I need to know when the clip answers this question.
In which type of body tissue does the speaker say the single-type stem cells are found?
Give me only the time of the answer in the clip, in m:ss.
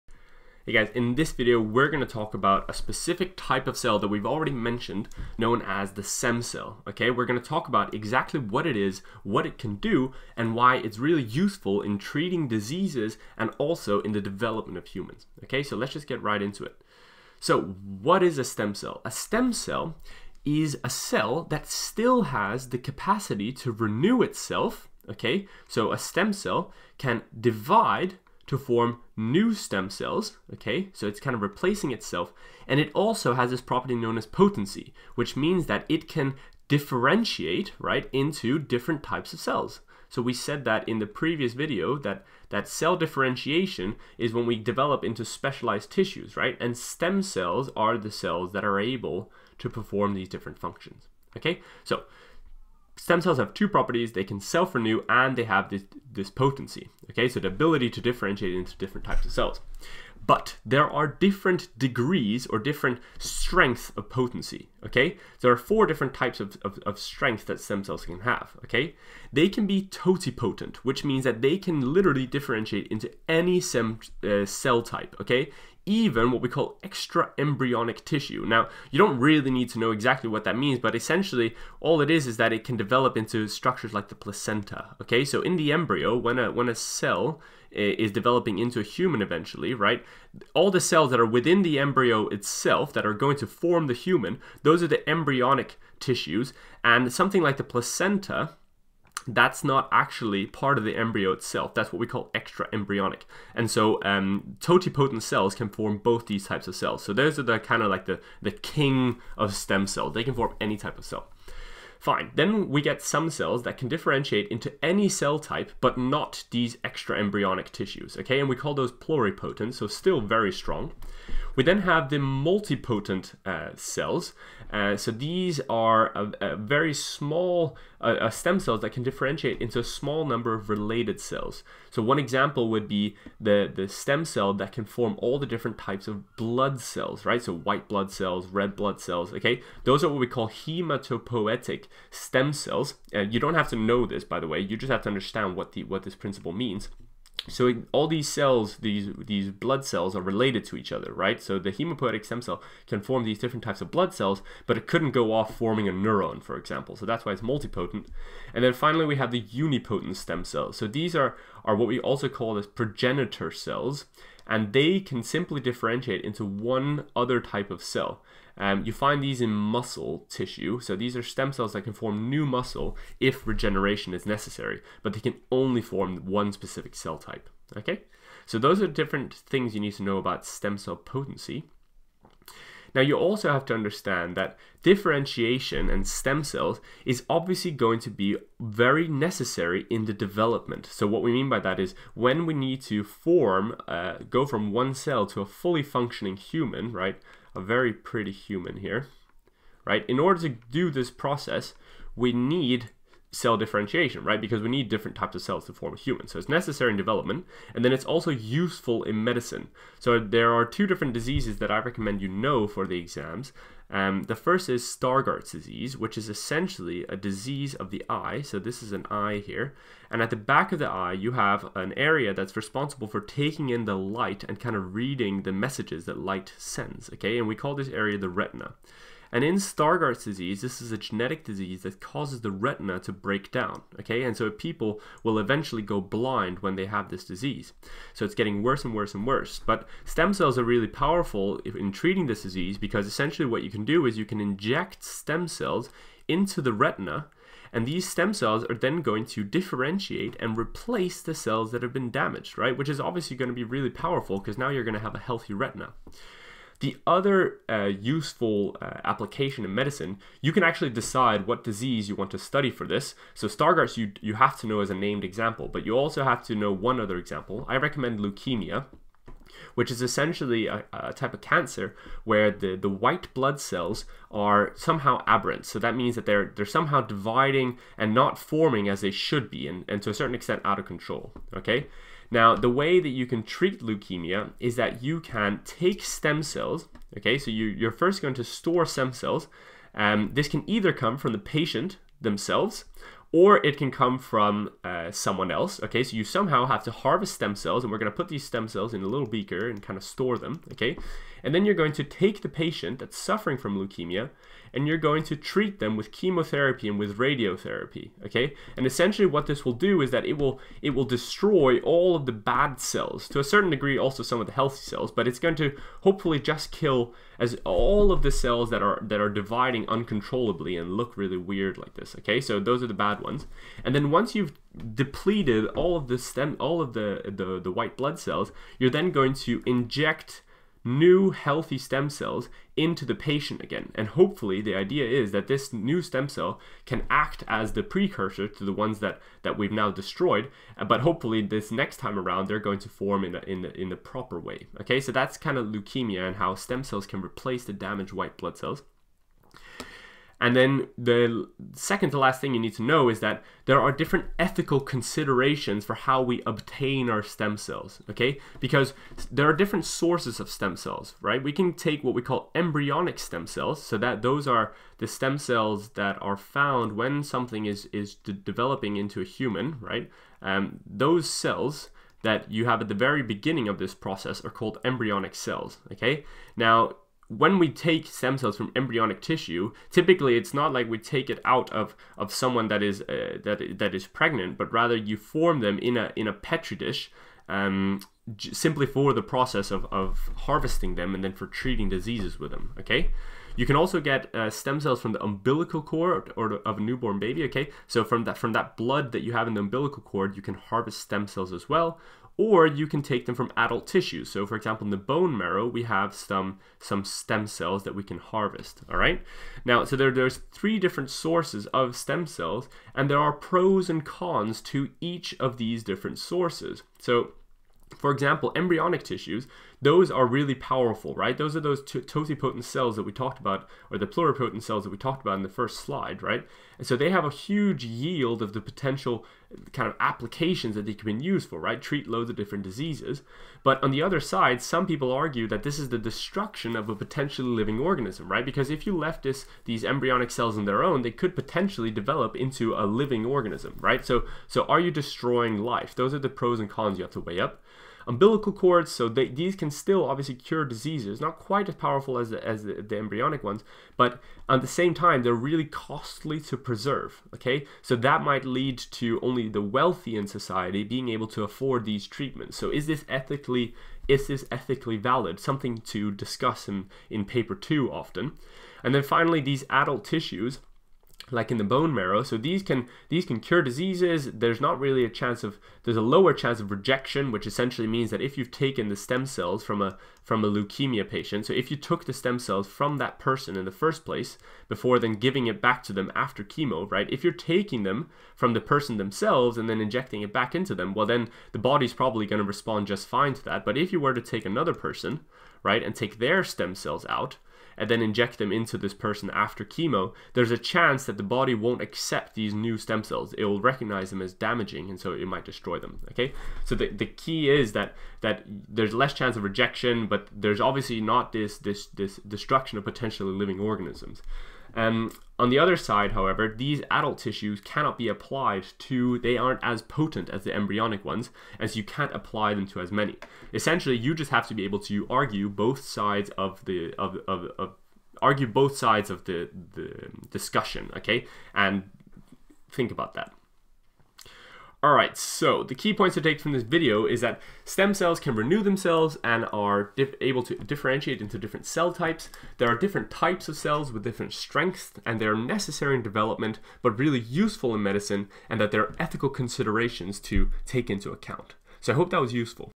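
2:49.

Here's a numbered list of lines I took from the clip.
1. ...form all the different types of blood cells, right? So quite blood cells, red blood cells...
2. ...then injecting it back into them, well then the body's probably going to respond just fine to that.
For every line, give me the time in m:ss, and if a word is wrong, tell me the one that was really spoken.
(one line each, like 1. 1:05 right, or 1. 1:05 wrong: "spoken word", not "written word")
1. 2:14 wrong: "white", not "quite"
2. 8:09 right.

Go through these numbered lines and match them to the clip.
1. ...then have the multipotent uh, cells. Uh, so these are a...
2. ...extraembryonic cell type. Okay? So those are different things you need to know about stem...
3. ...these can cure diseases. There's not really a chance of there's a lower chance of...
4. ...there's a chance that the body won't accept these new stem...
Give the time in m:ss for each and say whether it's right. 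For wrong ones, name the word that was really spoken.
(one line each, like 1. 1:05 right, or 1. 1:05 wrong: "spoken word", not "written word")
1. 2:01 right
2. 2:56 wrong: "specific", not "extraembryonic"
3. 7:53 right
4. 8:20 right.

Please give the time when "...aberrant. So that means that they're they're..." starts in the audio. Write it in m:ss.
4:35.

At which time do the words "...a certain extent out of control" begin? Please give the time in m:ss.
4:40.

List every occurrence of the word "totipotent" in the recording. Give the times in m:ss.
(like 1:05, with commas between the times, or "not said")
1:09, 1:44, 7:01.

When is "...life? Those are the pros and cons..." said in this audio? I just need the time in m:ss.
7:25.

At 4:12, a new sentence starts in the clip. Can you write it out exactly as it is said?
Which is obviously going to be really powerful because now you're going to have a healthy retina.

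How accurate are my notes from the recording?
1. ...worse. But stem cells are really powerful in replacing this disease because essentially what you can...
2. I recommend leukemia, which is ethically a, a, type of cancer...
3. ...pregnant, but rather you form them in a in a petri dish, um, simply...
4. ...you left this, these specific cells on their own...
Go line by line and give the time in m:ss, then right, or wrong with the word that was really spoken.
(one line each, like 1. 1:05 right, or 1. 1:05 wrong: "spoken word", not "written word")
1. 3:59 wrong: "treating", not "replacing"
2. 4:27 wrong: "essentially", not "ethically"
3. 6:24 right
4. 7:18 wrong: "embryonic", not "specific".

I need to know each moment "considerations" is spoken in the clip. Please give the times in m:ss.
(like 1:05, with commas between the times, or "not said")
5:54, 9:09.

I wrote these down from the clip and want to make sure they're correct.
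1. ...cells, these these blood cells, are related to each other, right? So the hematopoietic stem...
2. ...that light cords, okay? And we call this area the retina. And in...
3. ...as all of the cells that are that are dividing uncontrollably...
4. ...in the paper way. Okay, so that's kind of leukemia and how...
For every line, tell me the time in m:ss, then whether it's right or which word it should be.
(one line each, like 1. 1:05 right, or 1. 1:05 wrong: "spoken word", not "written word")
1. 2:28 right
2. 3:46 wrong: "sends", not "cords"
3. 5:17 right
4. 5:43 wrong: "proper", not "paper".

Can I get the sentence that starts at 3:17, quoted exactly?
a very pretty human here, right?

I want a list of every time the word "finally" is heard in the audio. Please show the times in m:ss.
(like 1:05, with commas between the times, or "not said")
2:38, 7:49.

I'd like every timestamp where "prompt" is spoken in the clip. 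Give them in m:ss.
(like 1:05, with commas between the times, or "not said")
not said.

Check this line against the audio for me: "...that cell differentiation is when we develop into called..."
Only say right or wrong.
wrong.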